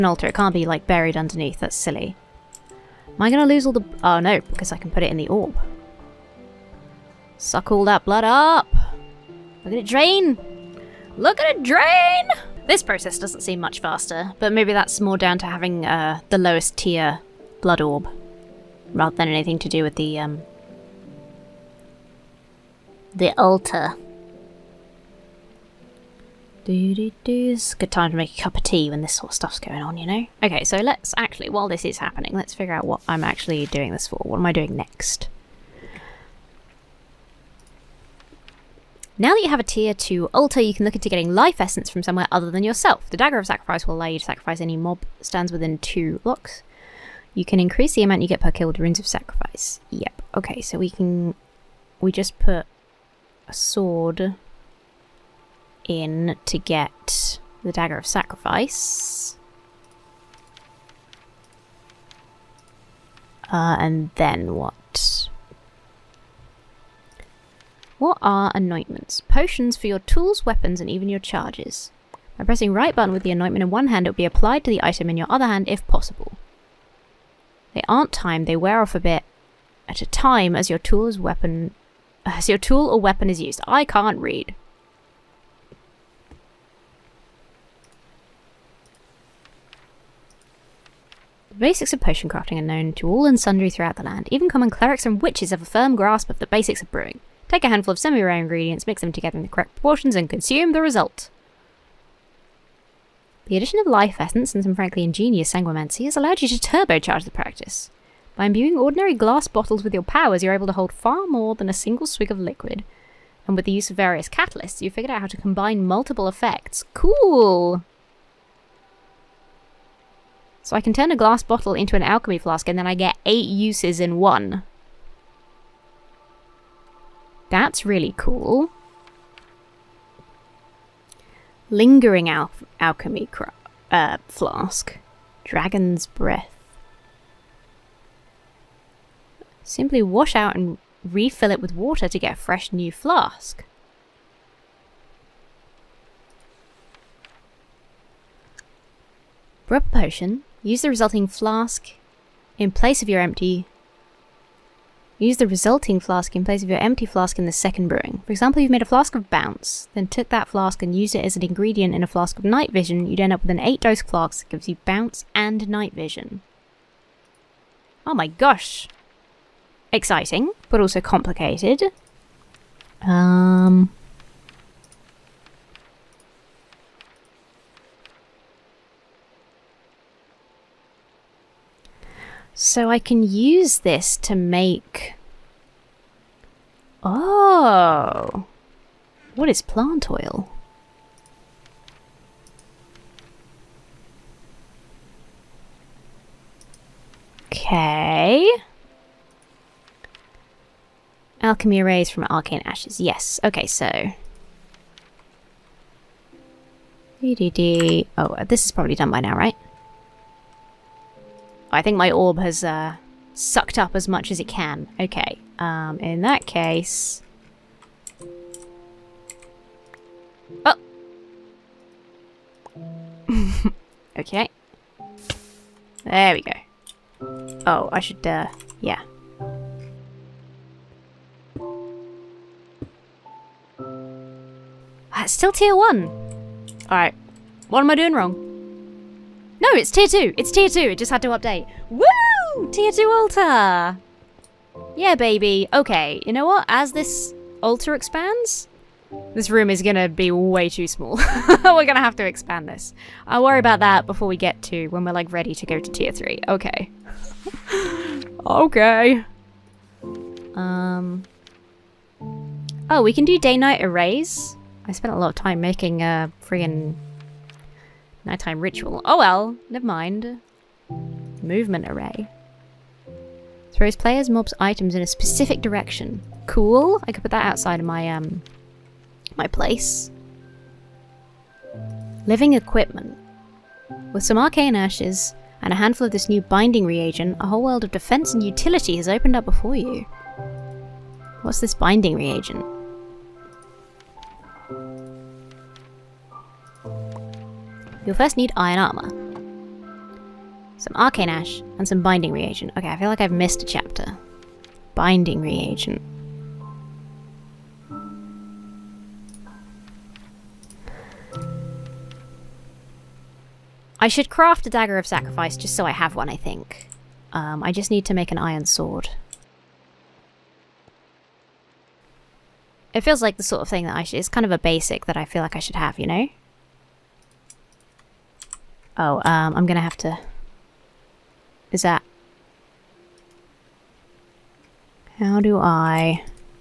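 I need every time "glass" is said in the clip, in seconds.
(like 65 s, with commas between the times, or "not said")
109 s, 121 s.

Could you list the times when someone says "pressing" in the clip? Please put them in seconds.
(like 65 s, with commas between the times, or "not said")
72 s.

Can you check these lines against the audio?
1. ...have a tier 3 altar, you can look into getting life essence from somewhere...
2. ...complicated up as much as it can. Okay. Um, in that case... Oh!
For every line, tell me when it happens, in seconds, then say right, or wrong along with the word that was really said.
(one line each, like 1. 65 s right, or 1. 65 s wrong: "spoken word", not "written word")
1. 39 s wrong: "2", not "3"
2. 213 s wrong: "sucked", not "complicated".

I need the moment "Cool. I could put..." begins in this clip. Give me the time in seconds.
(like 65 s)
276 s.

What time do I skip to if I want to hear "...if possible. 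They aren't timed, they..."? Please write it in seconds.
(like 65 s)
75 s.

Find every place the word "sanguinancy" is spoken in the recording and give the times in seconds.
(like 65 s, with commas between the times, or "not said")
105 s.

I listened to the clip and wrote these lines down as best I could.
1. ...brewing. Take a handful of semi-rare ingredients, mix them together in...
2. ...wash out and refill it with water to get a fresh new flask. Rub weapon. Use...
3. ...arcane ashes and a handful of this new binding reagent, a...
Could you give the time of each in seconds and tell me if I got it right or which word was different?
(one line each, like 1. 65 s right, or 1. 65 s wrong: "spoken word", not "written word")
1. 96 s right
2. 140 s wrong: "potion", not "weapon"
3. 284 s right.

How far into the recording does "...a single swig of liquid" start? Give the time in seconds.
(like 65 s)
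111 s.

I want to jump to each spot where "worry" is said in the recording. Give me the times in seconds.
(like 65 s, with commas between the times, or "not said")
253 s.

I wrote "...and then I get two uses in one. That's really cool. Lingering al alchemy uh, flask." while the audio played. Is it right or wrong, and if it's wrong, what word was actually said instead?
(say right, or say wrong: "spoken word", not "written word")
wrong: "eight", not "two".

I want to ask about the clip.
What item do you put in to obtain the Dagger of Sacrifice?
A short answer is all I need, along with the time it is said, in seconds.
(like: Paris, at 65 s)
A sword, at 53 s.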